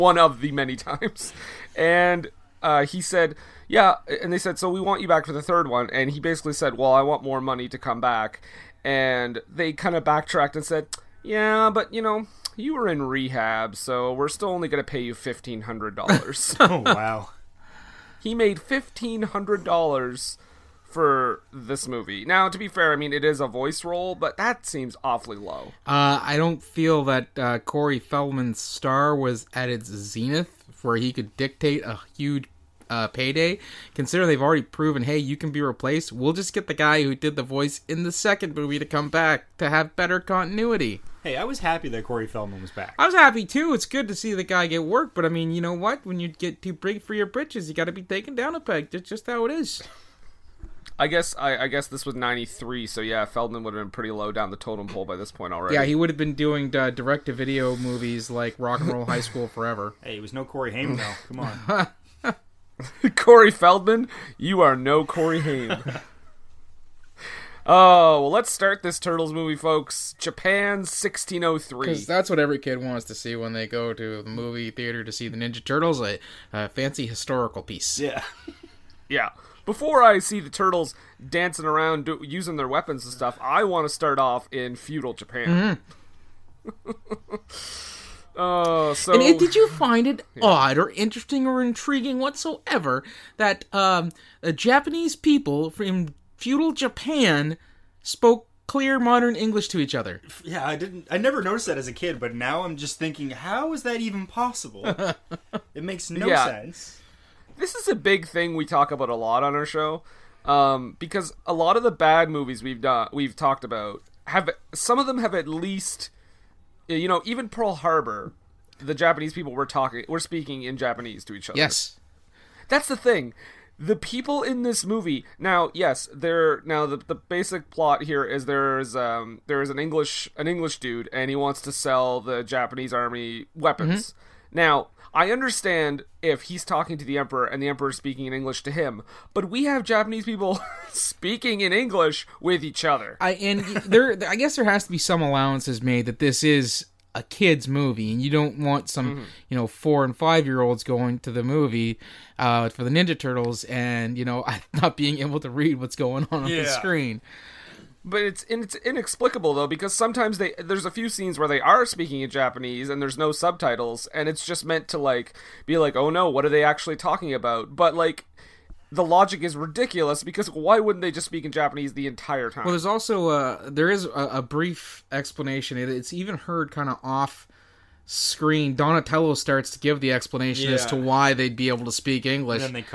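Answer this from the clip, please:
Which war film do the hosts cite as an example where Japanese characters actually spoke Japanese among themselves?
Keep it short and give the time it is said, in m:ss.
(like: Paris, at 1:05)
Pearl Harbor, at 1:57.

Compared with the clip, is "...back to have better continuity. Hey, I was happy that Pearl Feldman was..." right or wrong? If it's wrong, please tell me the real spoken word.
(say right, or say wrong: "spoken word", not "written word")
wrong: "Corey", not "Pearl".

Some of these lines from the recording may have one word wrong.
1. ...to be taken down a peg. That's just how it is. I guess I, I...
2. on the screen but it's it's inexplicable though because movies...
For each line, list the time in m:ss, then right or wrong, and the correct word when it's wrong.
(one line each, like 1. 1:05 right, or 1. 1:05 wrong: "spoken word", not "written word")
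1. 0:47 right
2. 2:36 wrong: "sometimes", not "movies".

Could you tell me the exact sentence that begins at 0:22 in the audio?
Now, to be fair, I mean it is a voice role, but that seems awfully low.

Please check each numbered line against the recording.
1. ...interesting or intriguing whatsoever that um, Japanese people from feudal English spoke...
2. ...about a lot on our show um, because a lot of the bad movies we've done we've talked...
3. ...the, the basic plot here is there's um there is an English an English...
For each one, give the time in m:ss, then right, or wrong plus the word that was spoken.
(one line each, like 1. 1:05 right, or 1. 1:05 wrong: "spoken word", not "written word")
1. 1:30 wrong: "Japan", not "English"
2. 1:48 right
3. 2:06 right.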